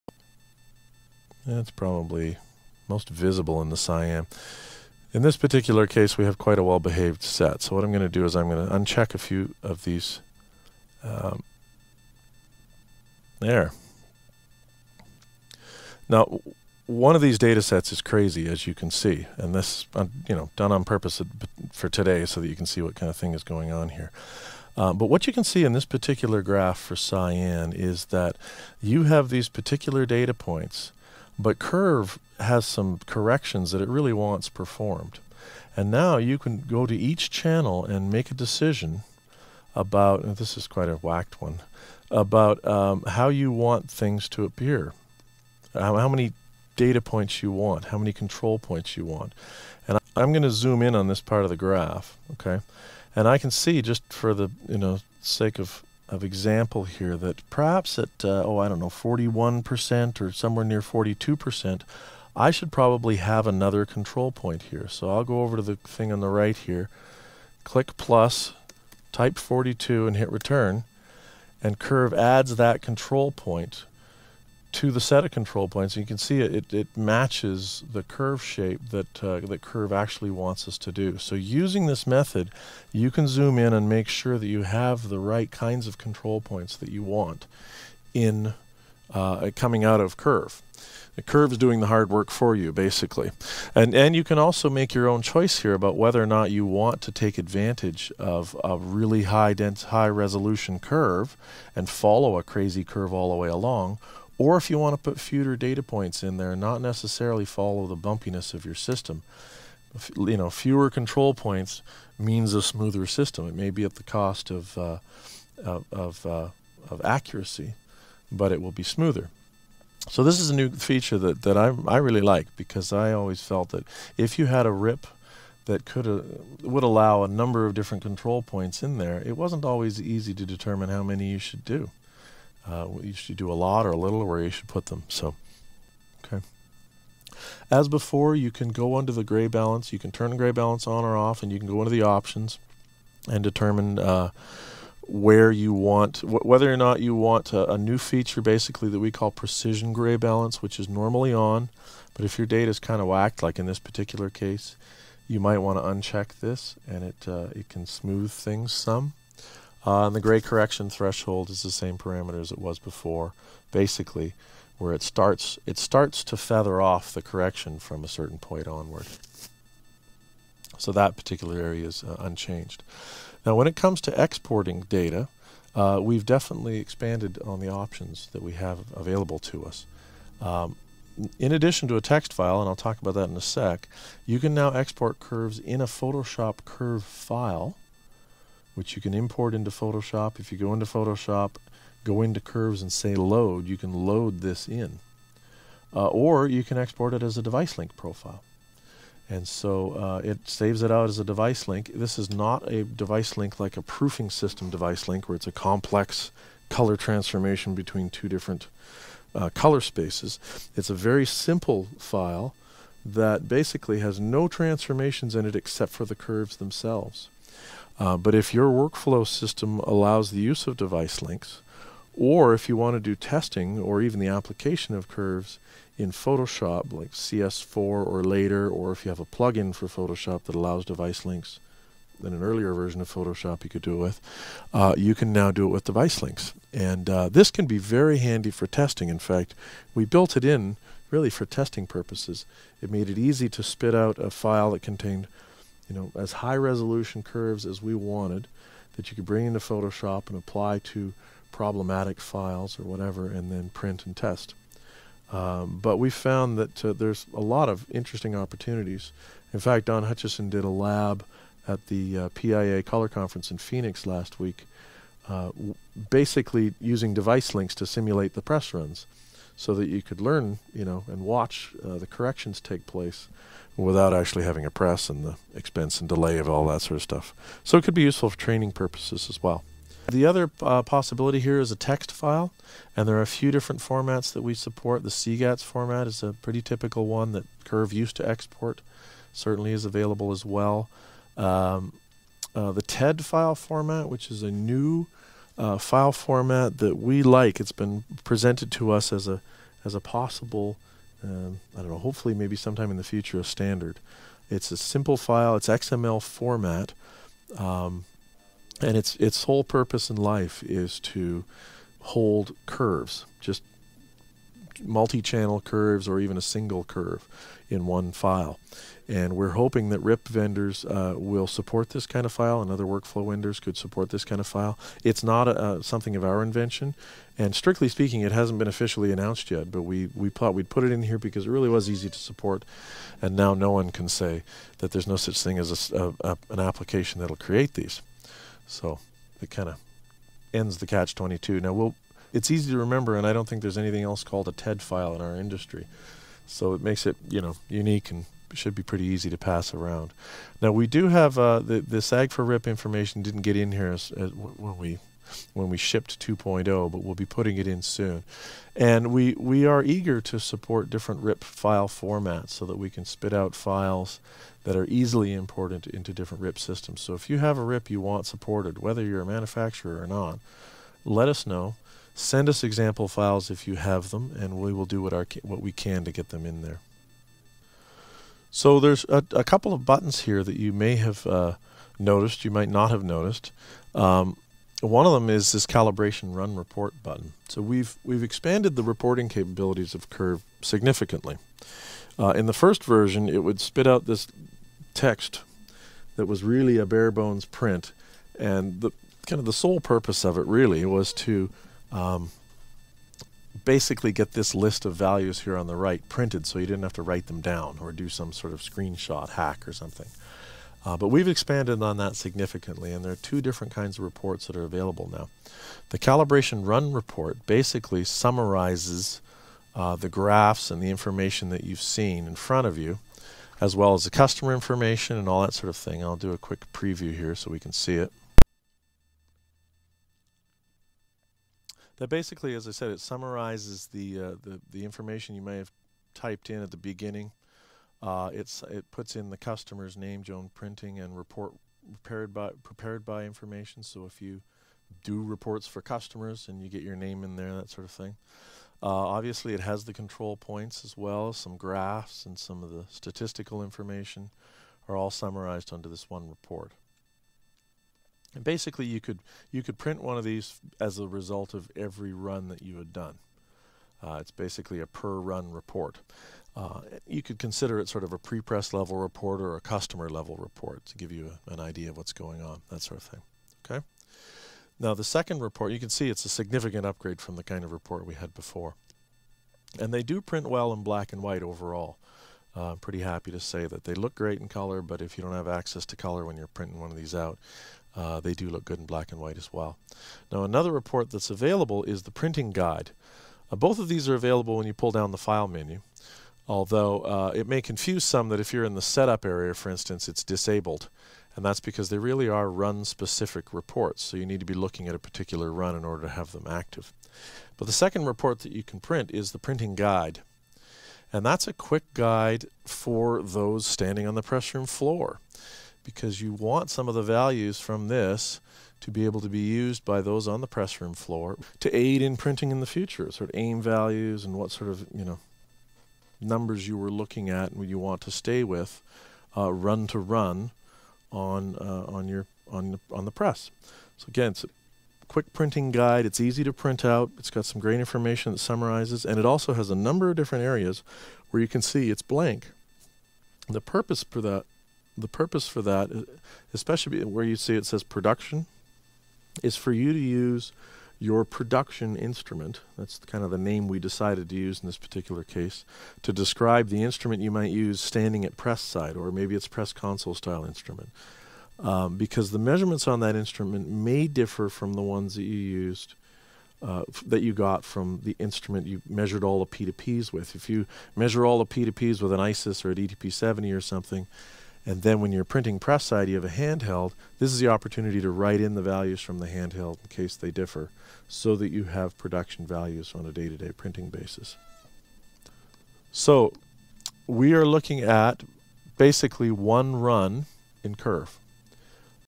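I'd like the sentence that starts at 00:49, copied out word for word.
And I'm going to zoom in on this part of the graph, okay?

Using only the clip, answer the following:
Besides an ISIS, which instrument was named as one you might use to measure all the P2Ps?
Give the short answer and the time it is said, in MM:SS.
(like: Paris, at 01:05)
DTP 70, at 09:32.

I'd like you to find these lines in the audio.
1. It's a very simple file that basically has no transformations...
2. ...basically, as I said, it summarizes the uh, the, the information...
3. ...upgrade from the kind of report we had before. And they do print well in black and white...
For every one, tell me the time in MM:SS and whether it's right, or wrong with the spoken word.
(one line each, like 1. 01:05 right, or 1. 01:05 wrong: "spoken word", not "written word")
1. 03:30 right
2. 07:12 right
3. 07:56 right.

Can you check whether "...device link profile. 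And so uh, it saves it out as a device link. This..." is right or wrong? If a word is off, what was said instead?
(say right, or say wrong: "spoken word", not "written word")
right.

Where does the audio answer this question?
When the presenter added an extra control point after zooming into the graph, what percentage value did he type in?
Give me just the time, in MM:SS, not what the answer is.
01:09.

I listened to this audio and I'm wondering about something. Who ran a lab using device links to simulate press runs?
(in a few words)
Don Hutchison.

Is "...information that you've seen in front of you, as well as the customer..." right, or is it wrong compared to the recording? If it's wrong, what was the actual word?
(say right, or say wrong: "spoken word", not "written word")
right.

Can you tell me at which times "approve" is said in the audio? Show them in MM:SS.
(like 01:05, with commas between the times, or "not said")
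not said.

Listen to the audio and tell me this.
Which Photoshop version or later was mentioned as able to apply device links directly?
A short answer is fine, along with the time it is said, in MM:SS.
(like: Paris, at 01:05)
CS4, at 03:47.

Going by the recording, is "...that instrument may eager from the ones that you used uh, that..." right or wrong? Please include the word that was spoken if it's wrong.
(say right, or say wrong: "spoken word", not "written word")
wrong: "differ", not "eager".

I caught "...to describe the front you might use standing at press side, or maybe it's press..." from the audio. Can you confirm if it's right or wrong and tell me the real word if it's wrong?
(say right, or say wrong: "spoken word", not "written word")
wrong: "instrument", not "front".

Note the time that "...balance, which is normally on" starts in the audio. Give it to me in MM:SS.
02:30.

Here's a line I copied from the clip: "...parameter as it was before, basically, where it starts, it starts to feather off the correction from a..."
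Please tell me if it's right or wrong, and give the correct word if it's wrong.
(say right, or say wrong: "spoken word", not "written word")
right.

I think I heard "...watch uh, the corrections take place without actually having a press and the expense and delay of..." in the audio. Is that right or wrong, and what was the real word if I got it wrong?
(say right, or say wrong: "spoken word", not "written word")
right.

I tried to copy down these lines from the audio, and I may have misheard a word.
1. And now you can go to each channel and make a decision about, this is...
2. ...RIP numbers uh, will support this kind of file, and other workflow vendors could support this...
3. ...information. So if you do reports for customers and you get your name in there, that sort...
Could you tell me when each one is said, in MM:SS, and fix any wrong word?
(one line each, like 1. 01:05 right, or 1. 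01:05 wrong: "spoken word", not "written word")
1. 00:35 right
2. 05:19 wrong: "vendors", not "numbers"
3. 07:23 right.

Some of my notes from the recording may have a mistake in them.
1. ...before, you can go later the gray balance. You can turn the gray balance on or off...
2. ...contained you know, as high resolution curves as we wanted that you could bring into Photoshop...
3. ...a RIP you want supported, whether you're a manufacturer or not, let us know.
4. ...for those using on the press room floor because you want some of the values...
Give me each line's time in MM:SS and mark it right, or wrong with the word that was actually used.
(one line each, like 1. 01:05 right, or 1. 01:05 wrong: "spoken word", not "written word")
1. 02:17 wrong: "under", not "later"
2. 04:04 right
3. 06:07 right
4. 08:32 wrong: "standing", not "using".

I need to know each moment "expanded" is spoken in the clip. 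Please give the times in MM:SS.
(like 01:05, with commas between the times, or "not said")
02:56, 06:28, 06:51.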